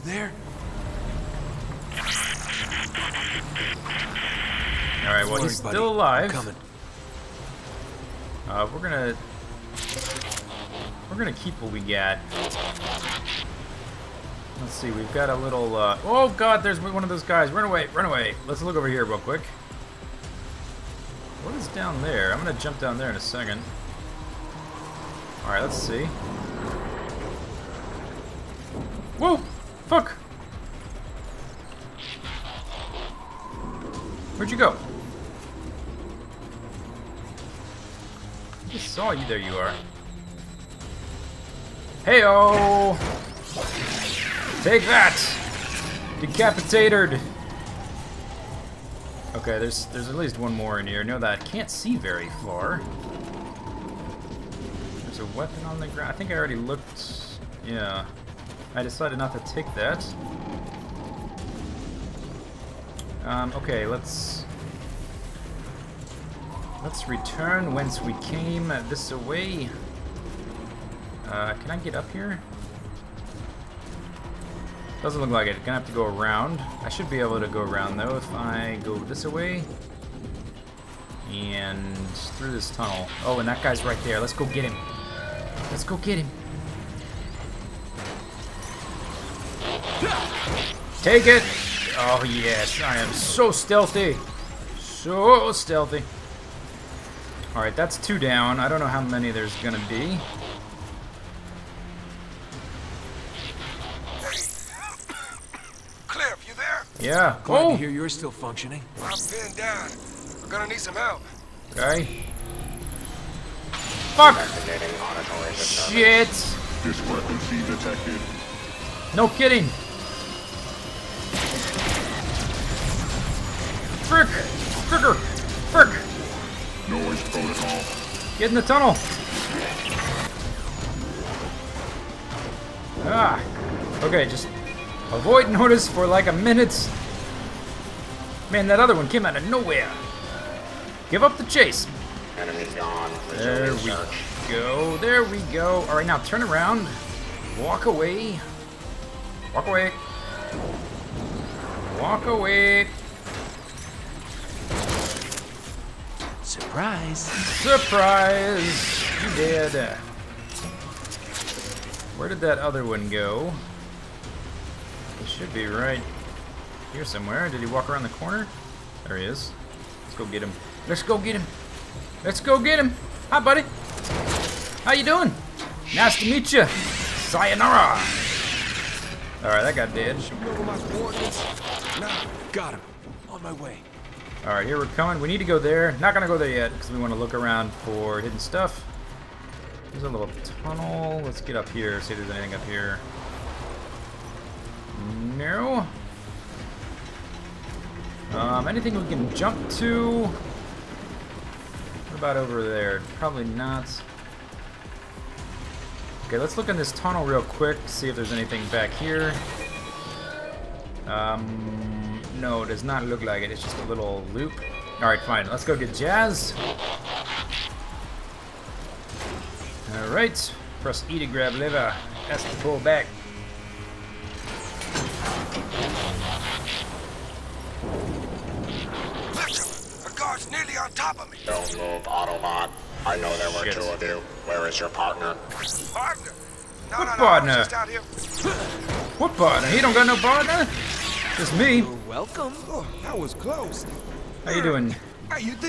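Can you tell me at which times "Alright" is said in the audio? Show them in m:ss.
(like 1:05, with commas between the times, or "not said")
0:05, 0:25, 1:37, 3:34, 3:39.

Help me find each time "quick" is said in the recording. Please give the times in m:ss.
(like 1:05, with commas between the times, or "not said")
0:19, 3:27.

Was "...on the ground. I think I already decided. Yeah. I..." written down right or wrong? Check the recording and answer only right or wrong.
wrong.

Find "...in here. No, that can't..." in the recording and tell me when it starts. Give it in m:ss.
0:50.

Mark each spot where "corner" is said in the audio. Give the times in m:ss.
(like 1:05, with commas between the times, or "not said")
2:48.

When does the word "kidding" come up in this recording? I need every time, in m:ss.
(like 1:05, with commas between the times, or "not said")
1:59.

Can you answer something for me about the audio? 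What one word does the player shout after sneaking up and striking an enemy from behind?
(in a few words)
Decapitated.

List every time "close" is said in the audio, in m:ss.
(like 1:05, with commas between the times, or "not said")
4:03.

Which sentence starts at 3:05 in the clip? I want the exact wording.
Not gonna go there yet because we want to look around for hidden stuff.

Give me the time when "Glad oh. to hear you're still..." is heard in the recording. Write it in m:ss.
1:47.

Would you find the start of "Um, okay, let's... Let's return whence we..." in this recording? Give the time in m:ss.
1:03.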